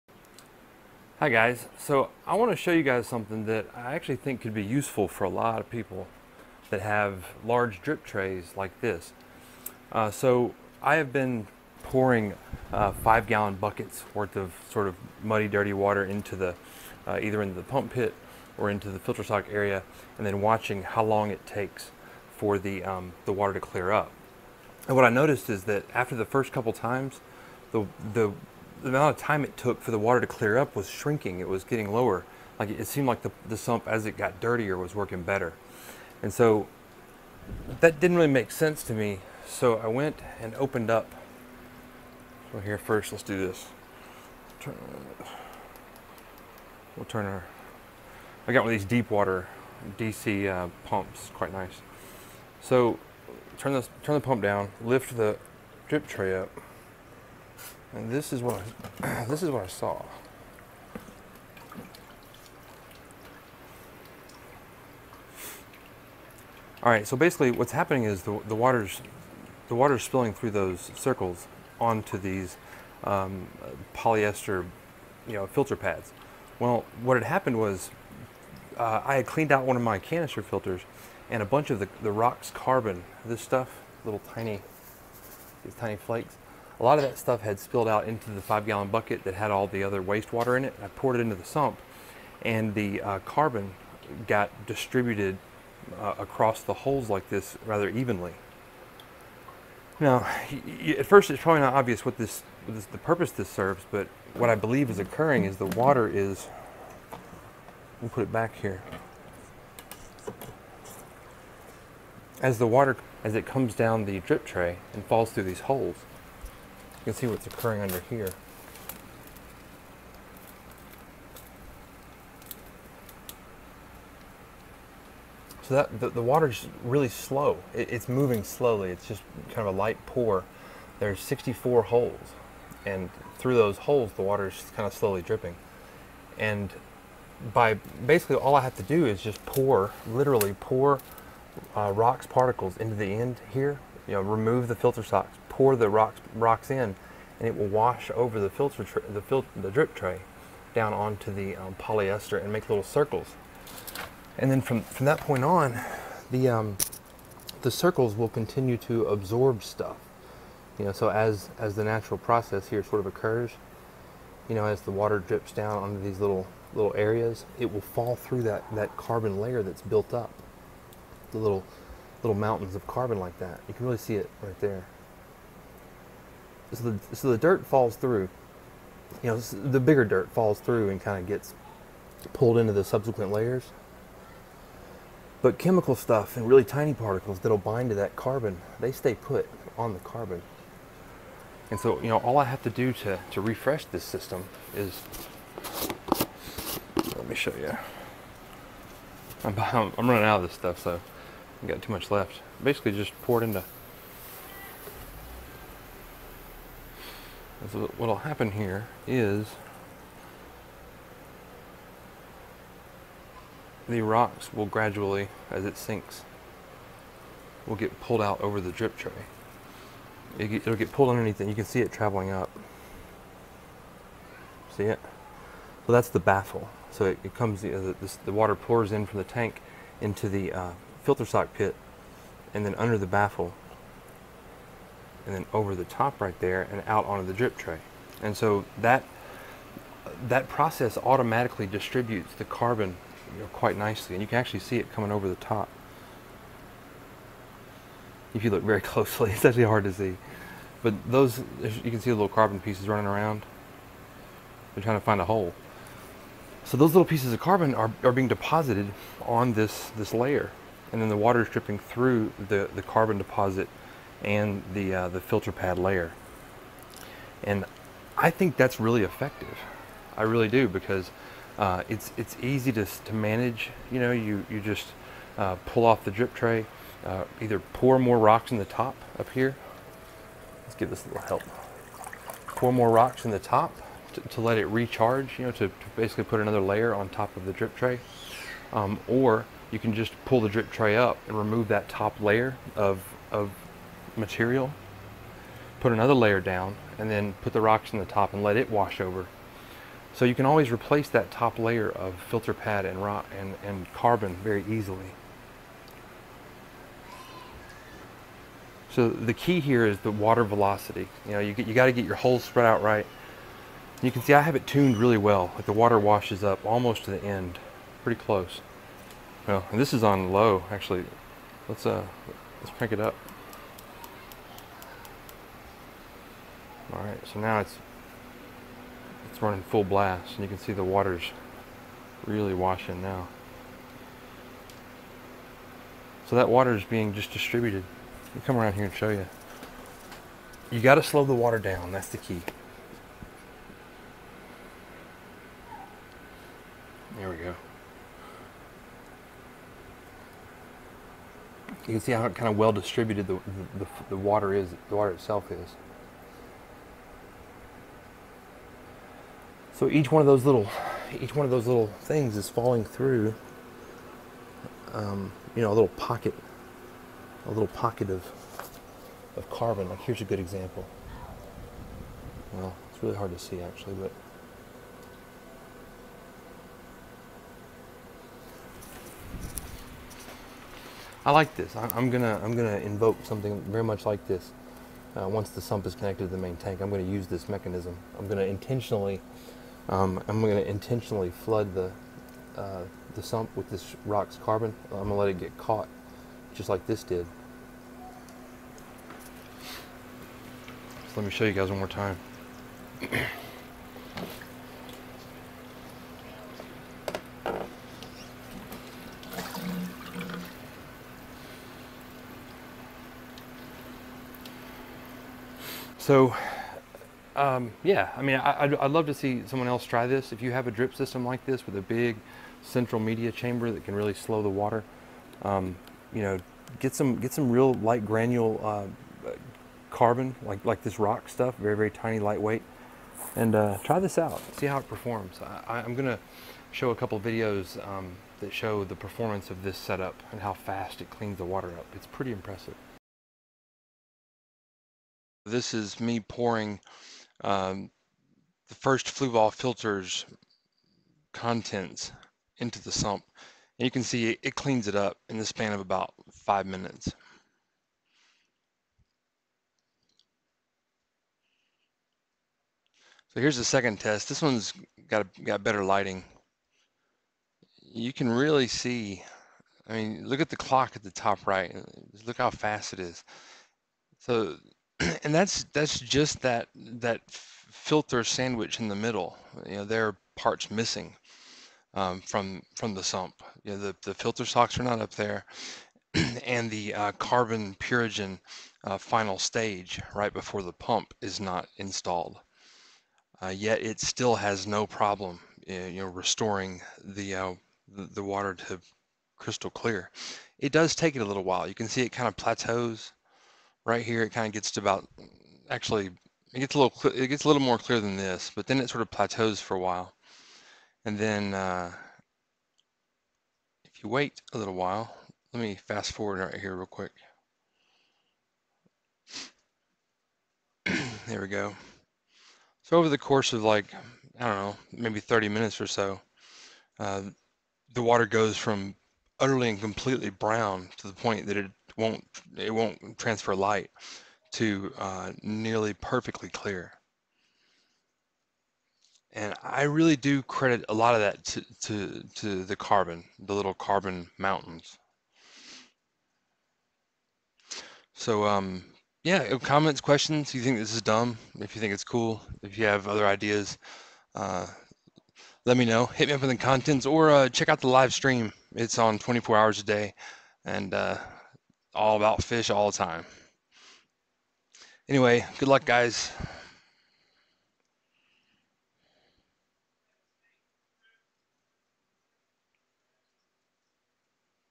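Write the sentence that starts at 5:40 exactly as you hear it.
You got to slow the water down.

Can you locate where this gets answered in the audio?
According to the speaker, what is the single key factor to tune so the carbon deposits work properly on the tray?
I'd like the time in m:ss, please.
5:10.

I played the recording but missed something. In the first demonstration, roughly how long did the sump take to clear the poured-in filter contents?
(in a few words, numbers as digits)
about five minutes.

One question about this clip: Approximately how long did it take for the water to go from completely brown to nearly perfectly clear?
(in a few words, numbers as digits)
30 minutes.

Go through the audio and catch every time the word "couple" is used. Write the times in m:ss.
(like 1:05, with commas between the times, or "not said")
0:26, 7:16.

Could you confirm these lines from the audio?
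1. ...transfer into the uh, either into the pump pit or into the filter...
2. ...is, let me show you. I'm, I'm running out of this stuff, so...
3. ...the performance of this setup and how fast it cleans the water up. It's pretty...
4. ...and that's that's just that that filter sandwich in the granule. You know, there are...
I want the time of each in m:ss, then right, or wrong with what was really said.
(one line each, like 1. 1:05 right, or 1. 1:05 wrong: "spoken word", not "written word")
1. 0:15 wrong: "water", not "transfer"
2. 3:14 right
3. 7:18 right
4. 7:55 wrong: "middle", not "granule".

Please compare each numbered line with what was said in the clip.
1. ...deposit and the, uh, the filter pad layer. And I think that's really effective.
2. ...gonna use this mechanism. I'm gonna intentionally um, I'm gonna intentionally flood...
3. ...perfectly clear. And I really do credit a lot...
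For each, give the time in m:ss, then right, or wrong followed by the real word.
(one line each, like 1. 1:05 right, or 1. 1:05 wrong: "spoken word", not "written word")
1. 4:23 right
2. 6:26 right
3. 8:56 right.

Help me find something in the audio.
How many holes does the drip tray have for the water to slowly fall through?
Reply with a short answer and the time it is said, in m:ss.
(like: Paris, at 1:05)
64, at 2:11.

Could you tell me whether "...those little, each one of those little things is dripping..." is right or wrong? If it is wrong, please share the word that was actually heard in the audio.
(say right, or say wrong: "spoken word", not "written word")
wrong: "falling", not "dripping".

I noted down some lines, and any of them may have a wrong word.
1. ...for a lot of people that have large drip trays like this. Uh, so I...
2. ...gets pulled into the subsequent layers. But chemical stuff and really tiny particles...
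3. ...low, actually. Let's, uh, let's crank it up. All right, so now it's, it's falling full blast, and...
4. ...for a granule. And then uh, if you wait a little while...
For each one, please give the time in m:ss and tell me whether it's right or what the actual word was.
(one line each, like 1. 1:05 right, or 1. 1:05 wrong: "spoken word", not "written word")
1. 0:05 right
2. 3:01 right
3. 5:20 wrong: "running", not "falling"
4. 8:29 wrong: "while", not "granule".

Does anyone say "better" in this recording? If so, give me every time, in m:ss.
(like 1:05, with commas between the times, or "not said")
0:35, 7:45.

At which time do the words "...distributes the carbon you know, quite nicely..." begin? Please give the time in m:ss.
4:01.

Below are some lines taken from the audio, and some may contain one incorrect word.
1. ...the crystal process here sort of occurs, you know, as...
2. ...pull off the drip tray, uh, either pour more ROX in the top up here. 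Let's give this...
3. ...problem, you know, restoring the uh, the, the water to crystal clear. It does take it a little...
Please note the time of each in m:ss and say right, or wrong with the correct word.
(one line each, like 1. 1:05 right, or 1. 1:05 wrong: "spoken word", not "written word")
1. 2:41 wrong: "natural", not "crystal"
2. 4:35 right
3. 8:14 right.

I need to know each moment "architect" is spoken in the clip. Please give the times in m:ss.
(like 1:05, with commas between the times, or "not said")
not said.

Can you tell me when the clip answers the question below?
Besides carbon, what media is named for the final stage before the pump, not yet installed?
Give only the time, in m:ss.
8:07.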